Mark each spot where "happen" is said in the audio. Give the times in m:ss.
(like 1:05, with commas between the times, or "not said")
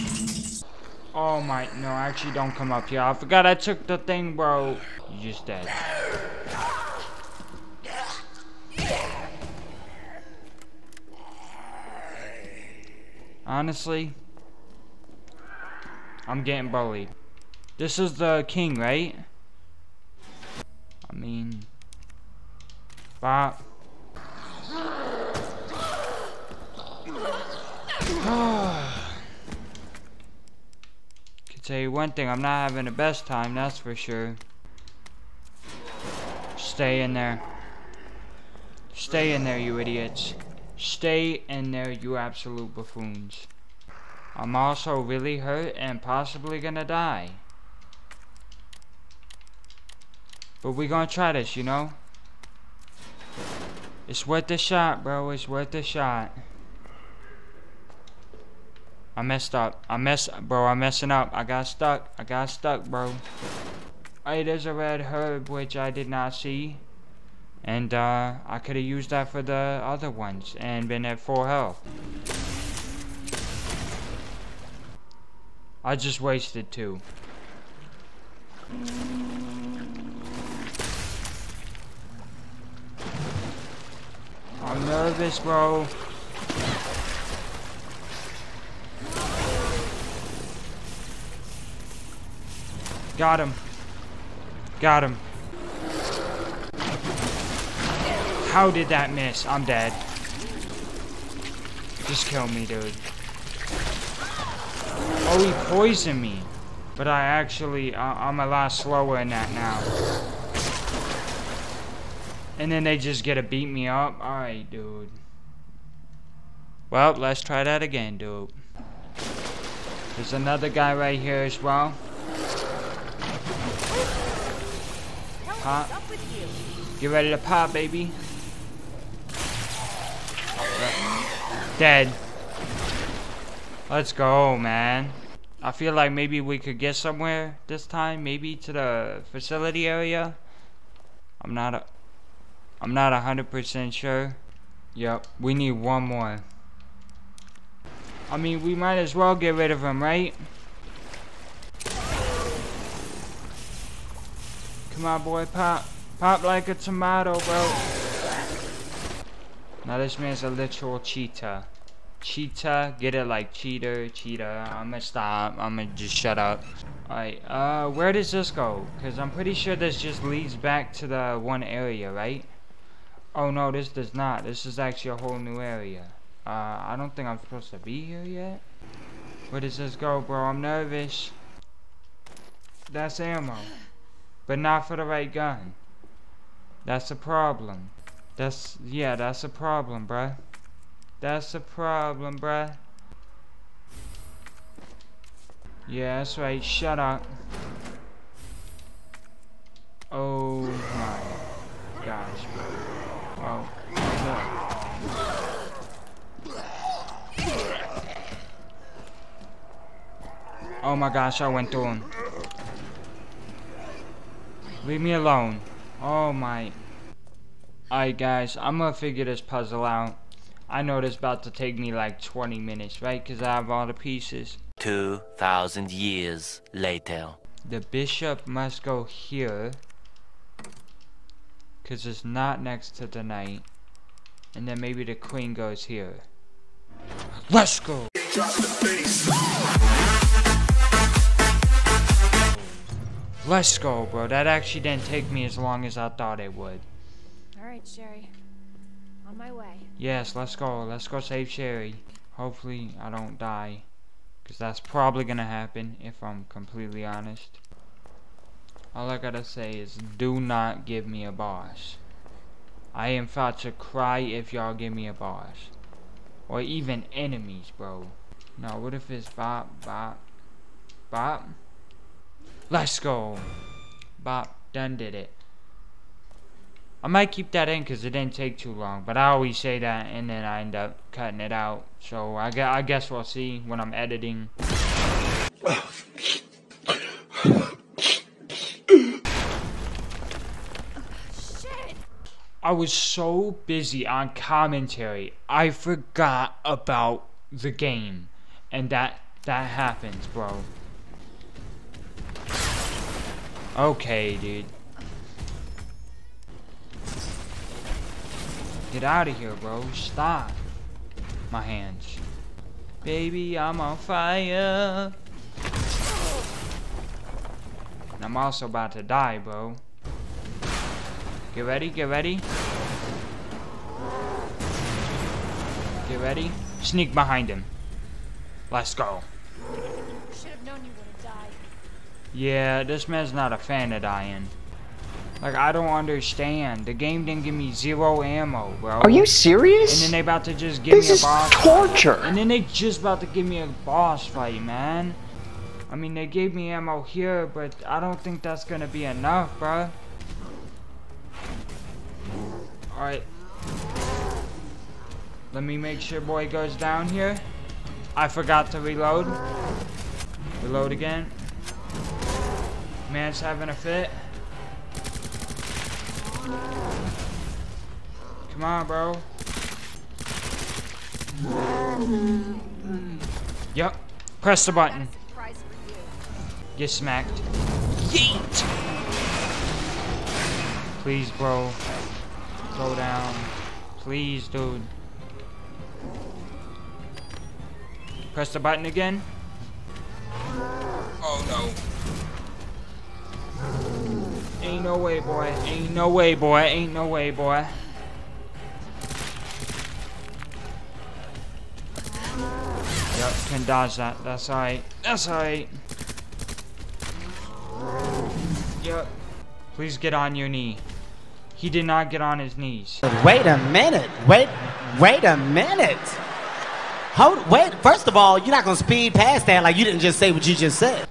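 4:15, 4:59.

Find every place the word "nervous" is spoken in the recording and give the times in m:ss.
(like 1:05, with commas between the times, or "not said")
1:24, 3:00.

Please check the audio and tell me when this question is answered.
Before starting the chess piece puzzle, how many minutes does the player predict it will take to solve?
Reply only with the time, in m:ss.
3:42.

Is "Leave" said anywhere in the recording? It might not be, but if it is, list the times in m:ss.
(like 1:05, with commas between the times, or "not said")
3:34.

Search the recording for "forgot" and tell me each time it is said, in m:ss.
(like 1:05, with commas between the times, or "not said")
0:03, 4:55, 5:58.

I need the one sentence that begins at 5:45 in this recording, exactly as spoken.
I mean, they gave me ammo here, but I don't think that's gonna be enough, bro.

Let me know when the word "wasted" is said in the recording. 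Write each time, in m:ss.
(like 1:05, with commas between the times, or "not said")
1:16.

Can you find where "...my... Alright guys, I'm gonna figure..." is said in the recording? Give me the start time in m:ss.
3:36.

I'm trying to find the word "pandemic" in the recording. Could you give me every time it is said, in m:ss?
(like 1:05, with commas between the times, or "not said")
not said.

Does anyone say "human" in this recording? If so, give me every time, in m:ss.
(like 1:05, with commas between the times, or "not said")
not said.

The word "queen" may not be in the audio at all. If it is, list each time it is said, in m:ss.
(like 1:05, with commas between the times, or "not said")
3:55.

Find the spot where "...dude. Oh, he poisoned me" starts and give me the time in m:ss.
1:42.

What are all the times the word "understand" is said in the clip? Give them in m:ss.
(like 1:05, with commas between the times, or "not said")
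5:35.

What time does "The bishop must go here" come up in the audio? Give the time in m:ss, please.
3:47.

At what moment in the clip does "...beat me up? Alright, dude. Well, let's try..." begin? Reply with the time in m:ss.
1:53.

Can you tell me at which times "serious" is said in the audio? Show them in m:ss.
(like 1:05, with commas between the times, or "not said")
5:39.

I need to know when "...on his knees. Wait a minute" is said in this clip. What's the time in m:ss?
6:52.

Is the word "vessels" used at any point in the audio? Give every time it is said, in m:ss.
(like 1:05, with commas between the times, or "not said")
not said.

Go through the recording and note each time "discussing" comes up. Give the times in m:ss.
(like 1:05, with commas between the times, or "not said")
not said.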